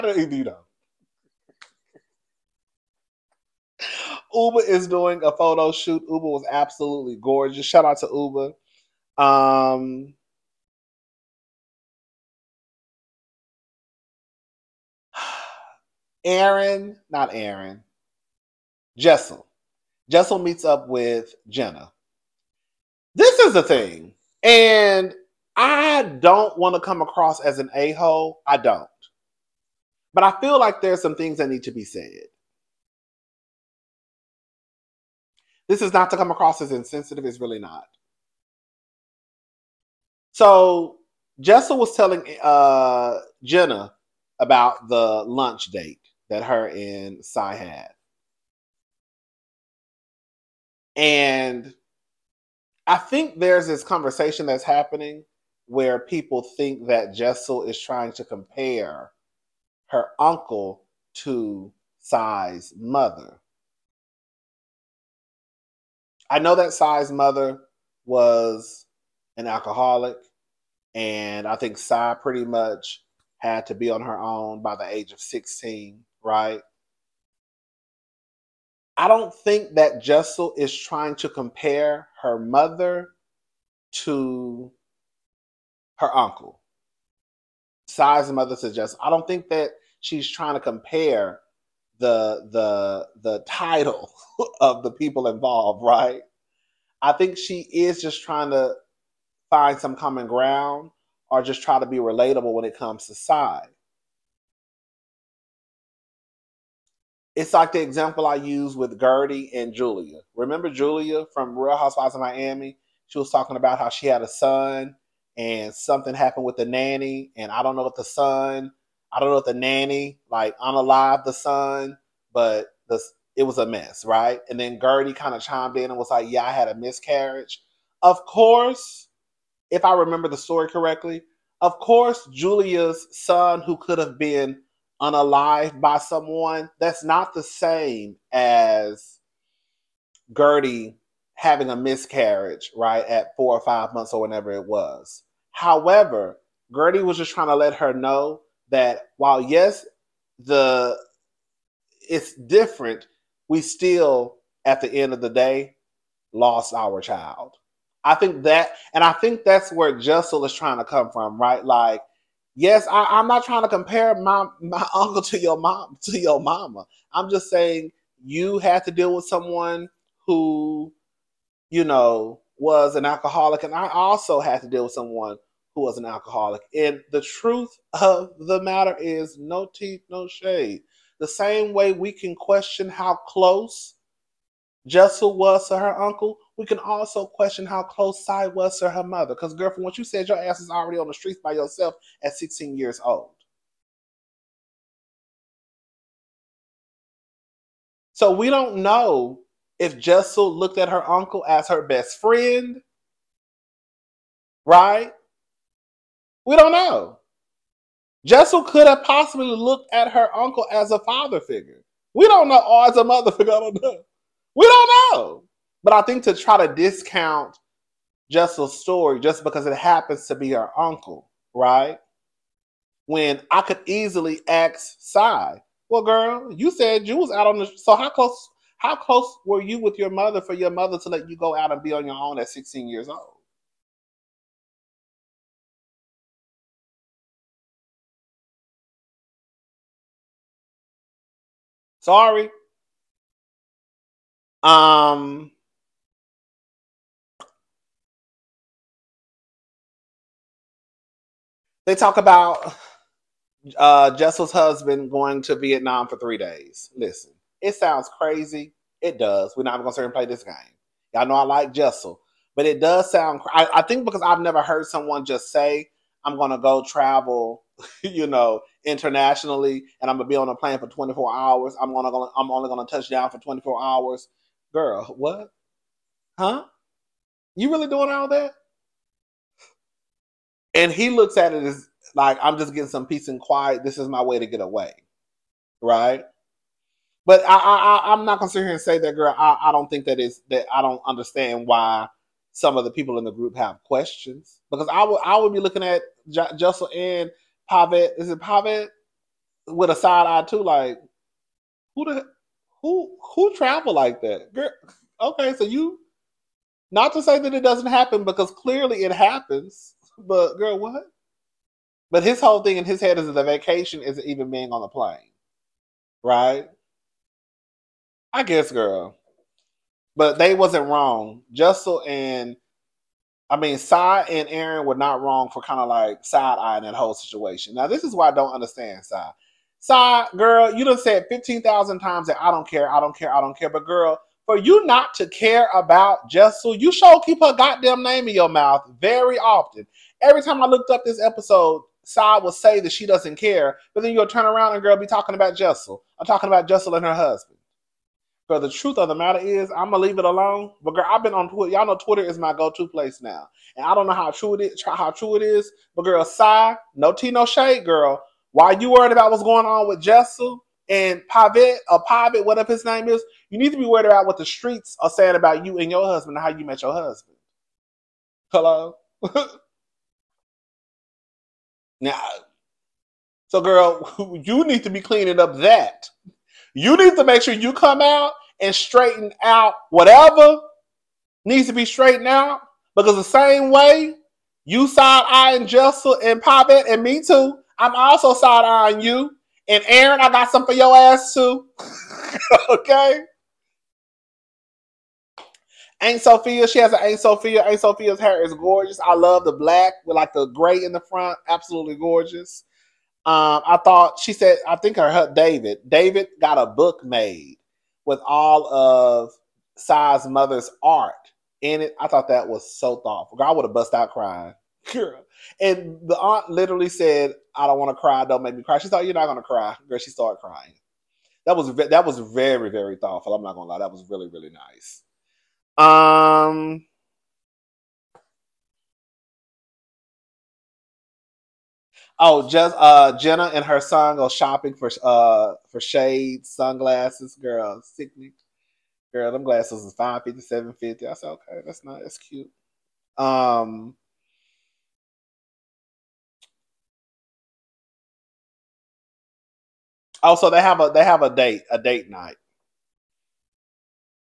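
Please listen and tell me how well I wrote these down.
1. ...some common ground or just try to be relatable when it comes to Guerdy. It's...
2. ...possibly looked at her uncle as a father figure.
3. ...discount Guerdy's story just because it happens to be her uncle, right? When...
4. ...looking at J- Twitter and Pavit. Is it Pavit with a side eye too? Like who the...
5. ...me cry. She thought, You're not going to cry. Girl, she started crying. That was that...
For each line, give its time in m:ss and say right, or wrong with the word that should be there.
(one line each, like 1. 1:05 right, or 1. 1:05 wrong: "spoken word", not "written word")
1. 1:39 wrong: "Sai", not "Guerdy"
2. 3:29 right
3. 3:36 wrong: "Jessel", not "Guerdy"
4. 4:55 wrong: "Jessel", not "Twitter"
5. 6:58 right.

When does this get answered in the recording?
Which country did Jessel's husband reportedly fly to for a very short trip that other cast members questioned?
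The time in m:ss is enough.
4:15.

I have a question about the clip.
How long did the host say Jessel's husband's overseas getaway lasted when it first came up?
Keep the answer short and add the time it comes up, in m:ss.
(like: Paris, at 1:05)
3 days, at 4:16.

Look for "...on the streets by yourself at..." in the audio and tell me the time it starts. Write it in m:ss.
3:10.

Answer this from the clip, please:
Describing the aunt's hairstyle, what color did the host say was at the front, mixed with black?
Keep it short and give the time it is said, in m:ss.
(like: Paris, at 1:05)
Gray, at 6:40.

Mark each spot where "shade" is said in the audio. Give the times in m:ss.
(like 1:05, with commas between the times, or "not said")
3:00, 5:57, 7:15.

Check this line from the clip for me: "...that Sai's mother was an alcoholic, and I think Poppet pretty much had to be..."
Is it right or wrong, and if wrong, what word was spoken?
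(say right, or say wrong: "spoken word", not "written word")
wrong: "Sai", not "Poppet".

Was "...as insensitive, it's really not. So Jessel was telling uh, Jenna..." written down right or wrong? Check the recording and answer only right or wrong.
right.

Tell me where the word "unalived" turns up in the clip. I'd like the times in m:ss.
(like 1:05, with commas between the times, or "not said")
2:00, 2:14.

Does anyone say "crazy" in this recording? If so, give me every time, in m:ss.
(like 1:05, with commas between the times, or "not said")
4:18.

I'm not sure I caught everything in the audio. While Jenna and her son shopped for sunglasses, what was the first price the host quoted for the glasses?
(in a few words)
$550.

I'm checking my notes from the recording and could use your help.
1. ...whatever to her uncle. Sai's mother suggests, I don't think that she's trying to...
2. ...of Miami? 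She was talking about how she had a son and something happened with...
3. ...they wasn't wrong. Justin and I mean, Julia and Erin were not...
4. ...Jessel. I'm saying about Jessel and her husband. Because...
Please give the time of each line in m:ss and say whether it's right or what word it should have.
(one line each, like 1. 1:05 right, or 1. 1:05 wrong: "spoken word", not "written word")
1. 1:22 wrong: "mother", not "whatever"
2. 1:52 right
3. 5:20 wrong: "Sai", not "Julia"
4. 5:45 wrong: "talking", not "saying".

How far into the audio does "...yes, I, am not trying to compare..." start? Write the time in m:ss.
2:42.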